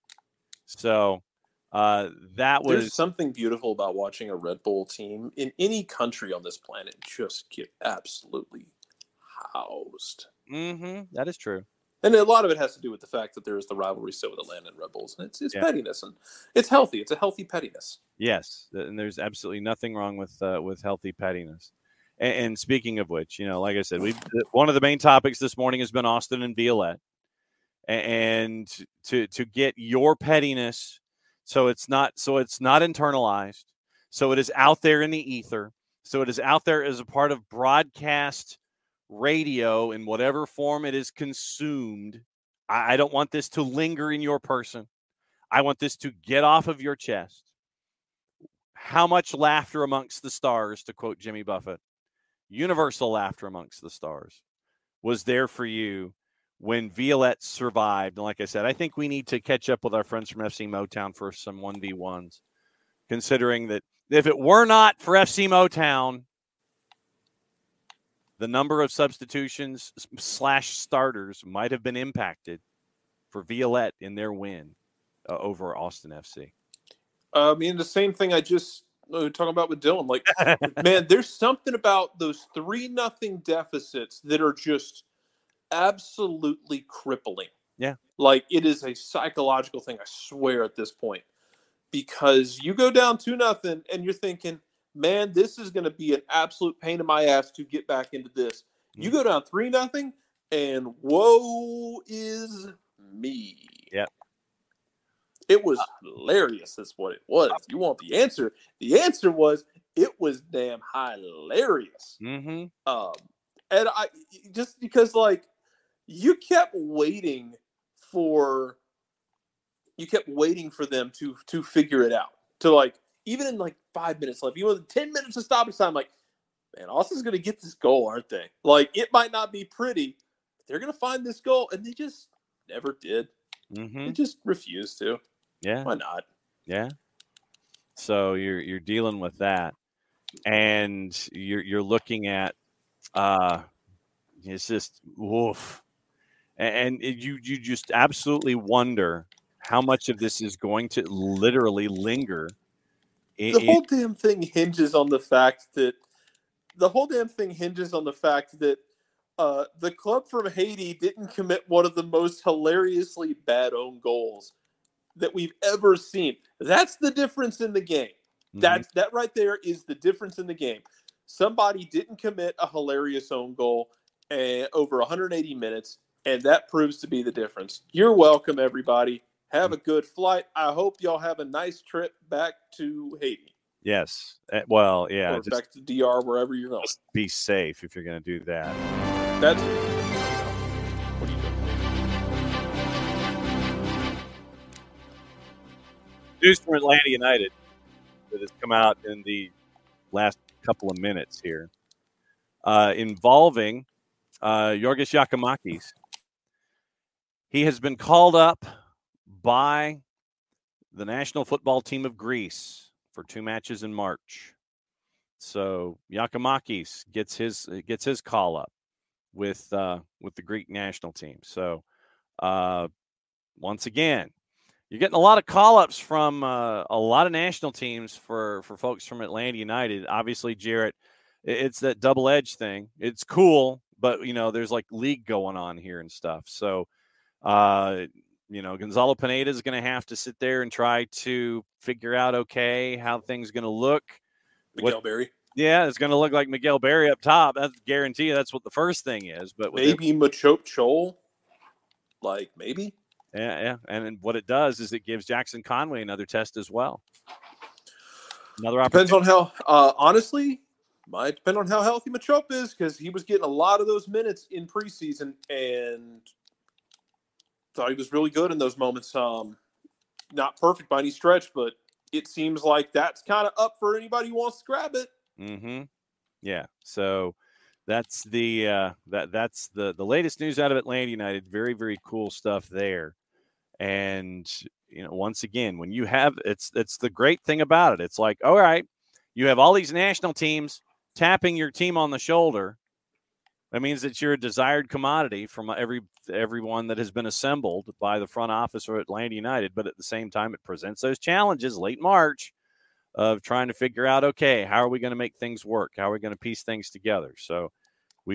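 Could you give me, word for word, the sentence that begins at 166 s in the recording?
That's the difference in the game.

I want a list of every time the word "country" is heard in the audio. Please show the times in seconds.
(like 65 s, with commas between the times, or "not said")
5 s.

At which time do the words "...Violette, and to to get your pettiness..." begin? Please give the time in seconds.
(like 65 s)
26 s.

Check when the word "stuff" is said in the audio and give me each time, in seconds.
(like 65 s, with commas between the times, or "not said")
236 s, 282 s.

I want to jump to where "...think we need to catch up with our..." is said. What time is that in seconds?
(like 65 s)
58 s.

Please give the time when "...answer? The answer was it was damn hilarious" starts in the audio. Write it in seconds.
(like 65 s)
108 s.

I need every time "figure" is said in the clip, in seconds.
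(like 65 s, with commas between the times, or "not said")
121 s, 241 s, 303 s.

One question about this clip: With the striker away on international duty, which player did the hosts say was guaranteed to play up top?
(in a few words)
Miguel Berry.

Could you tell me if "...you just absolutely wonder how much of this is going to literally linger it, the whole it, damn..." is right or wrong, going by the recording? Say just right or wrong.
right.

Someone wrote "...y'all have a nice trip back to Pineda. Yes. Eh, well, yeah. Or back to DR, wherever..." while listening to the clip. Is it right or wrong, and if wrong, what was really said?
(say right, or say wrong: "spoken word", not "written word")
wrong: "Haiti", not "Pineda".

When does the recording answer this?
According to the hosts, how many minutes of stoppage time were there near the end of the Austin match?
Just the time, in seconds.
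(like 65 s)
124 s.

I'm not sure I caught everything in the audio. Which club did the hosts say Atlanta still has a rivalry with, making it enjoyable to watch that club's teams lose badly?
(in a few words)
Red Bulls.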